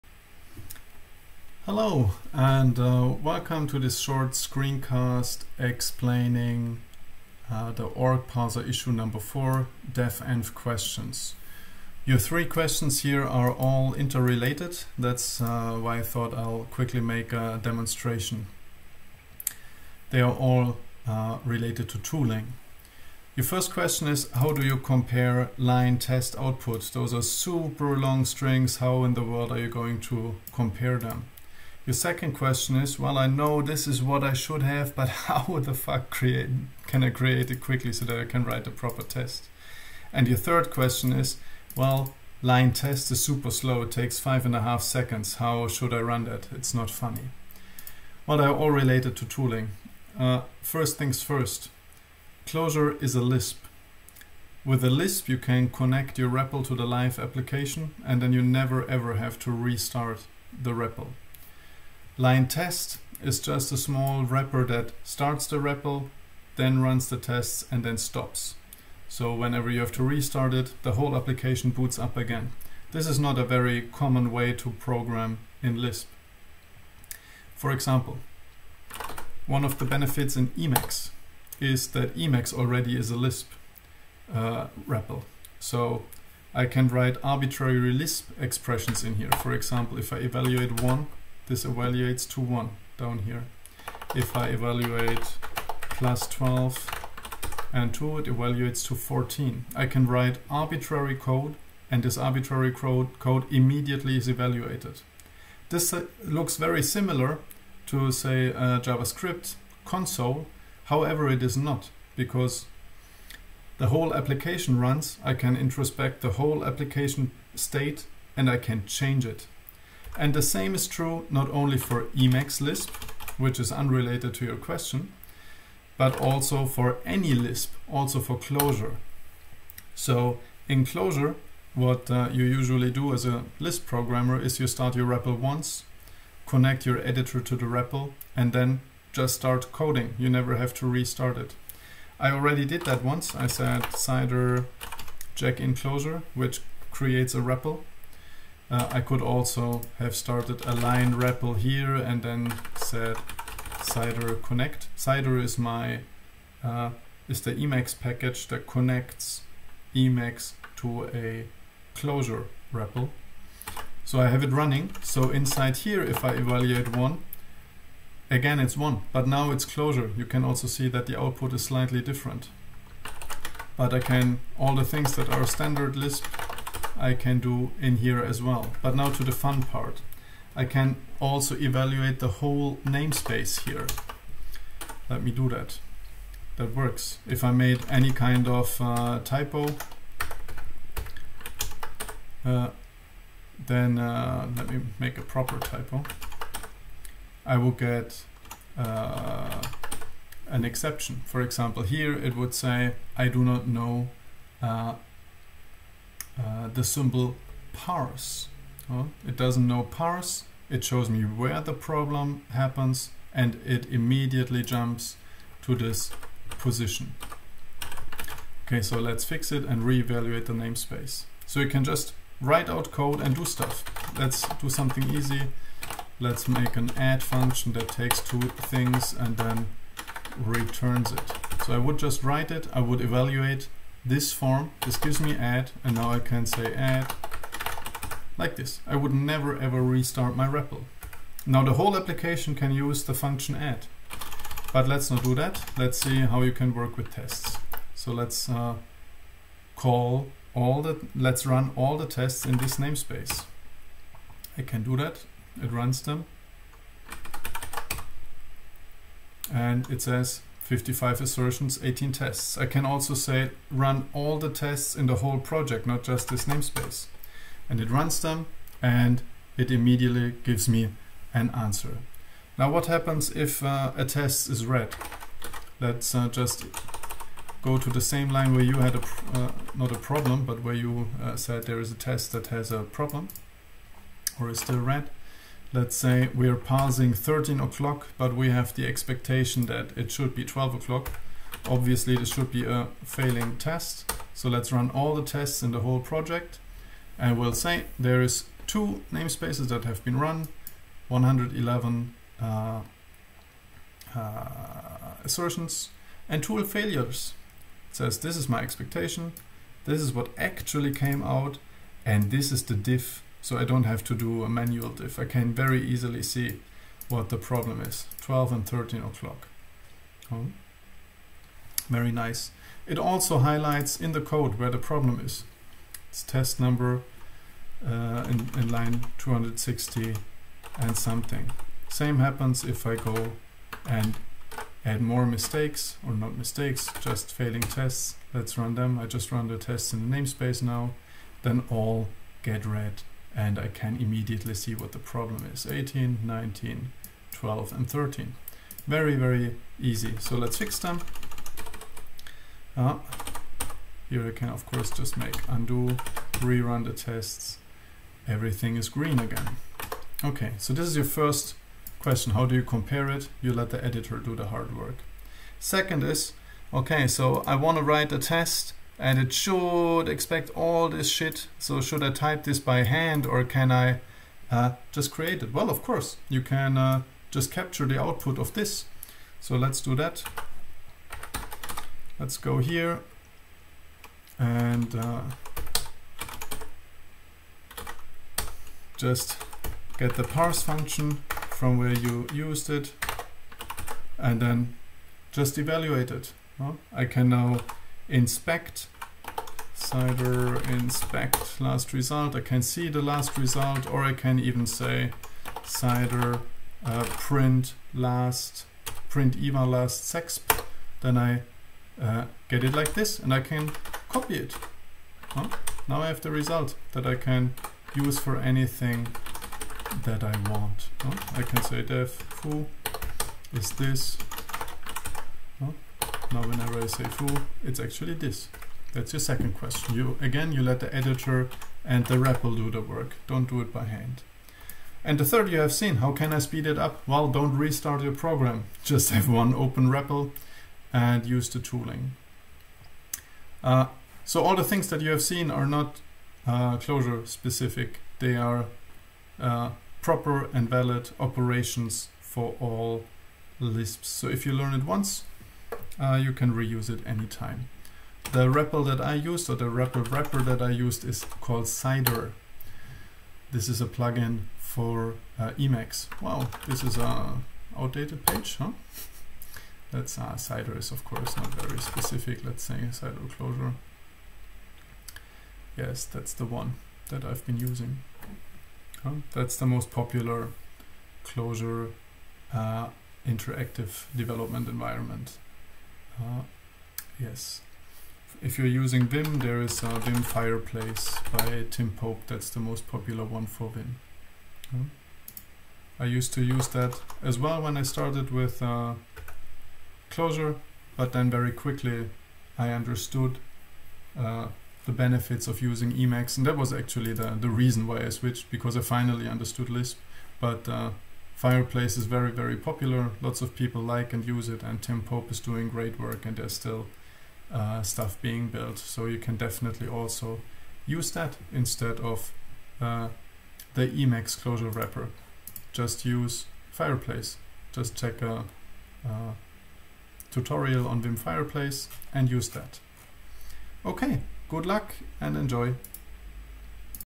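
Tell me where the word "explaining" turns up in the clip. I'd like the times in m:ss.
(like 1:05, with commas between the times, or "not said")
0:05.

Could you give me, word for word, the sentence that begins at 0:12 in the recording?
Your three questions here are all interrelated that's uh, why I thought I'll quickly make a demonstration.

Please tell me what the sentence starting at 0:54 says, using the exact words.
With a Lisp, you can connect your REPL to the live application and then you never ever have to restart the REPL.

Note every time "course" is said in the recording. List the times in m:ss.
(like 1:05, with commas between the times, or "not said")
5:54, 6:15, 7:51.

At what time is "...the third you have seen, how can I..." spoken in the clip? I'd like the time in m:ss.
7:15.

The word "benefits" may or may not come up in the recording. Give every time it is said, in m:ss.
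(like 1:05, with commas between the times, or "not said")
1:19, 8:24.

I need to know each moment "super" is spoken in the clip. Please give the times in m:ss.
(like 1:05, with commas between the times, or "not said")
0:27, 0:43.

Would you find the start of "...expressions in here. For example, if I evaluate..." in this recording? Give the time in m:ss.
1:28.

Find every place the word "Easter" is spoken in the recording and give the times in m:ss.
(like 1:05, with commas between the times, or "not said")
not said.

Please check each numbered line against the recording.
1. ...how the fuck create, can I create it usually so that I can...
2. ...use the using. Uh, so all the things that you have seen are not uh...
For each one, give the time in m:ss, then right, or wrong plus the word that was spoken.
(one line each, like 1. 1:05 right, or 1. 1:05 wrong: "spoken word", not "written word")
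1. 0:35 wrong: "quickly", not "usually"
2. 7:21 wrong: "tooling", not "using".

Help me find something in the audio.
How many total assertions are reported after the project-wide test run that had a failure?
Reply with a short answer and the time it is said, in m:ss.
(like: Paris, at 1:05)
111, at 5:01.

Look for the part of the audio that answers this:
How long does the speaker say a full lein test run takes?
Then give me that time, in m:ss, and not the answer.
0:44.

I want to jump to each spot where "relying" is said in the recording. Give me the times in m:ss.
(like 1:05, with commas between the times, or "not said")
not said.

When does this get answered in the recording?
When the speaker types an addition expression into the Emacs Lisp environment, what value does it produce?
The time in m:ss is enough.
1:38.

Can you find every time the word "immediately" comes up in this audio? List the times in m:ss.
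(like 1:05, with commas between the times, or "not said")
1:43, 3:33, 4:29, 5:43.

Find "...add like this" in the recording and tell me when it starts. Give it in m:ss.
3:56.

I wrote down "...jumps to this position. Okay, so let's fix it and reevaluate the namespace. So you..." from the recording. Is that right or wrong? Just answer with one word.
right.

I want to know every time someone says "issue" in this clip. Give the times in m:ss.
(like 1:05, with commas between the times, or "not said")
0:08.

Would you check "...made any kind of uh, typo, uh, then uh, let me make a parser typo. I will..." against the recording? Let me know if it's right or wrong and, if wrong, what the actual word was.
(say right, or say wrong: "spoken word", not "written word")
wrong: "proper", not "parser".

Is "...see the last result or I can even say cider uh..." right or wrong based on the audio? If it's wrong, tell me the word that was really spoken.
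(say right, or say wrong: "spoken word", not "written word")
right.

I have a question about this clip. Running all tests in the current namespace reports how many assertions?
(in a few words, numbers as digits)
55.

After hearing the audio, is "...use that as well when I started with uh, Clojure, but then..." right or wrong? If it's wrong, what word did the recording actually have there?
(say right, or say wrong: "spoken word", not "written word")
right.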